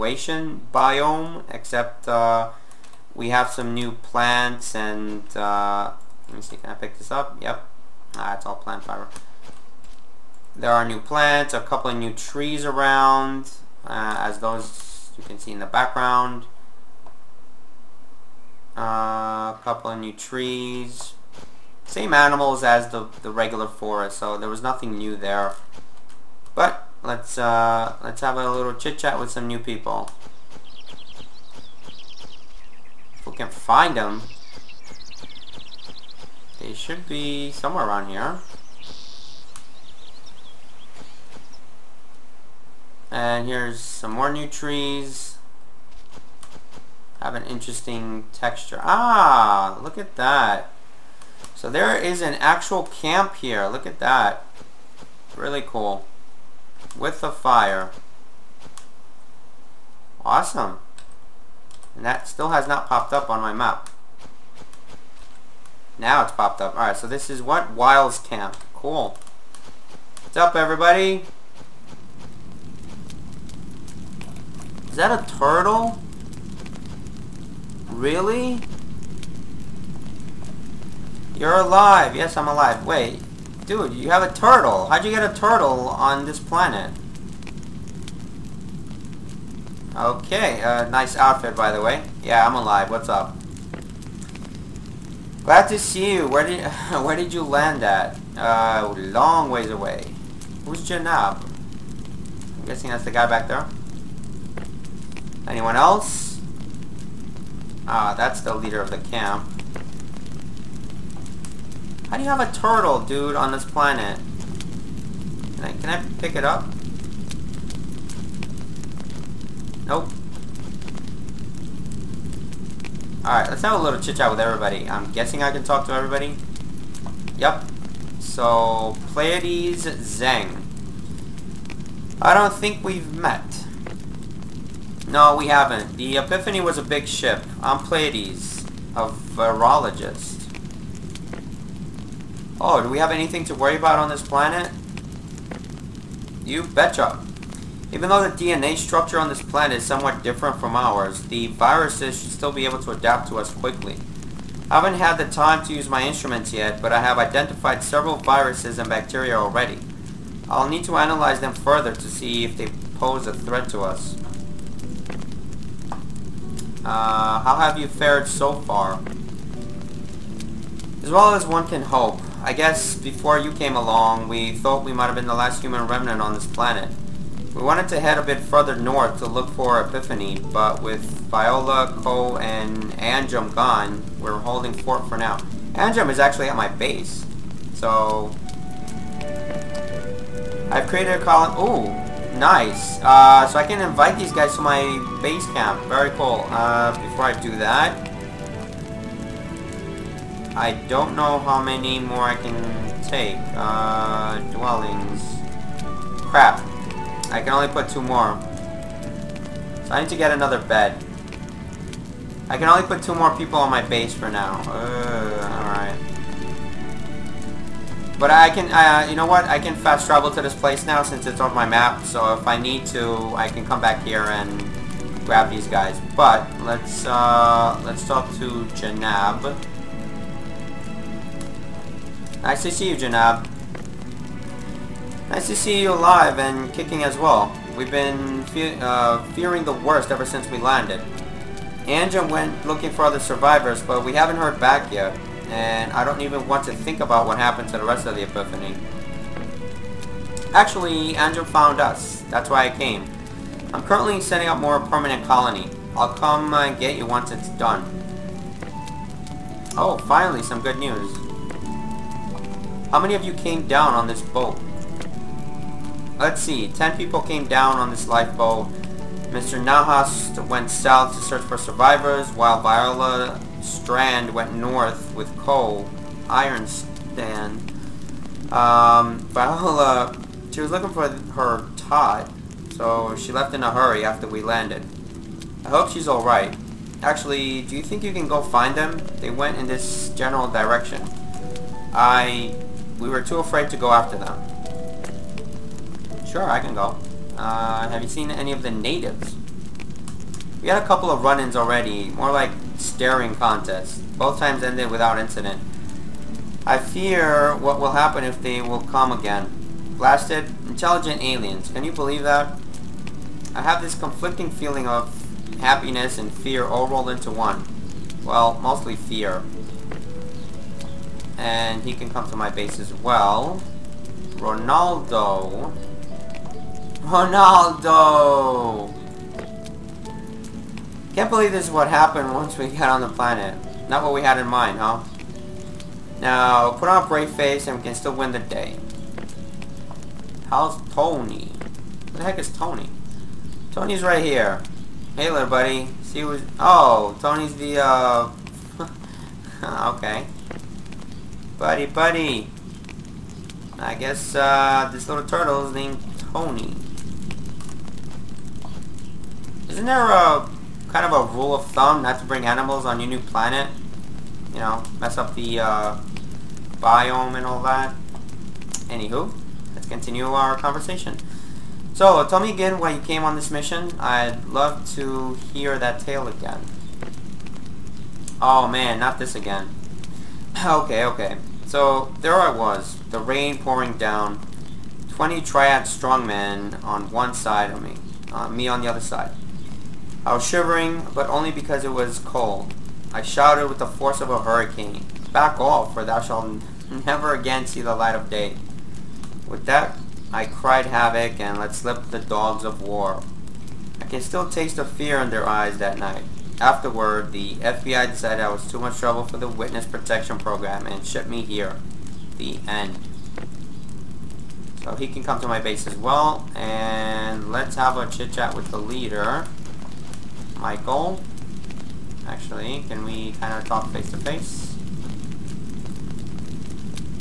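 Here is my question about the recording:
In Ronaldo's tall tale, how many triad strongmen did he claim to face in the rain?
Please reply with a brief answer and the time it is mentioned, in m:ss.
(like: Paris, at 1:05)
20, at 6:25.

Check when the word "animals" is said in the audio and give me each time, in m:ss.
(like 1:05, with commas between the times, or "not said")
0:22, 6:02.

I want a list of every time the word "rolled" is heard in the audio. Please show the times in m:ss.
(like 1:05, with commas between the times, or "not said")
5:16.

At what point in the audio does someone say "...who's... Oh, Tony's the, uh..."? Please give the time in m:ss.
5:46.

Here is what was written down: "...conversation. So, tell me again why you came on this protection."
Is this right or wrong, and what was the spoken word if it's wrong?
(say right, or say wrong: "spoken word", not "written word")
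wrong: "mission", not "protection".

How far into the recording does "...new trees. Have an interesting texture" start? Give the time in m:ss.
0:44.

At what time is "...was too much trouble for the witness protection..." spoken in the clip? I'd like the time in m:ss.
6:48.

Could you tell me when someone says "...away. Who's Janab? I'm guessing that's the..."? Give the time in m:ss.
1:39.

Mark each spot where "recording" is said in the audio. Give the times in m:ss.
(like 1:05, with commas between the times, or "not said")
not said.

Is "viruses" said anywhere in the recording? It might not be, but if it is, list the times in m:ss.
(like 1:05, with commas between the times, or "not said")
2:31, 2:38.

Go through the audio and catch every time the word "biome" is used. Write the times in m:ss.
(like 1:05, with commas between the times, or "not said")
0:00, 6:06.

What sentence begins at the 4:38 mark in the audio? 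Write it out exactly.
Um, Viola, she was looking for her Todd, so she left in a hurry after we landed.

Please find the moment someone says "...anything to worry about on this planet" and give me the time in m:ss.
2:23.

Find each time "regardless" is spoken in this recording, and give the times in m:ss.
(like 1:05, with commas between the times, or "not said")
not said.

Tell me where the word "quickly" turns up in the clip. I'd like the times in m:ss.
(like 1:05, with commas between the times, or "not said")
2:33.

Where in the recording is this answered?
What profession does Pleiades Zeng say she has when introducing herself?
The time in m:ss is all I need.
2:18.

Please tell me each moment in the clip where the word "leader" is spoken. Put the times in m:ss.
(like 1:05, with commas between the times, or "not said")
1:48, 6:58.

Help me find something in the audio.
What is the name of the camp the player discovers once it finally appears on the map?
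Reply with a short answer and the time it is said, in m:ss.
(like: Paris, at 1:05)
Wiles Camp, at 1:07.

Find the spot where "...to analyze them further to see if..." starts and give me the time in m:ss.
2:40.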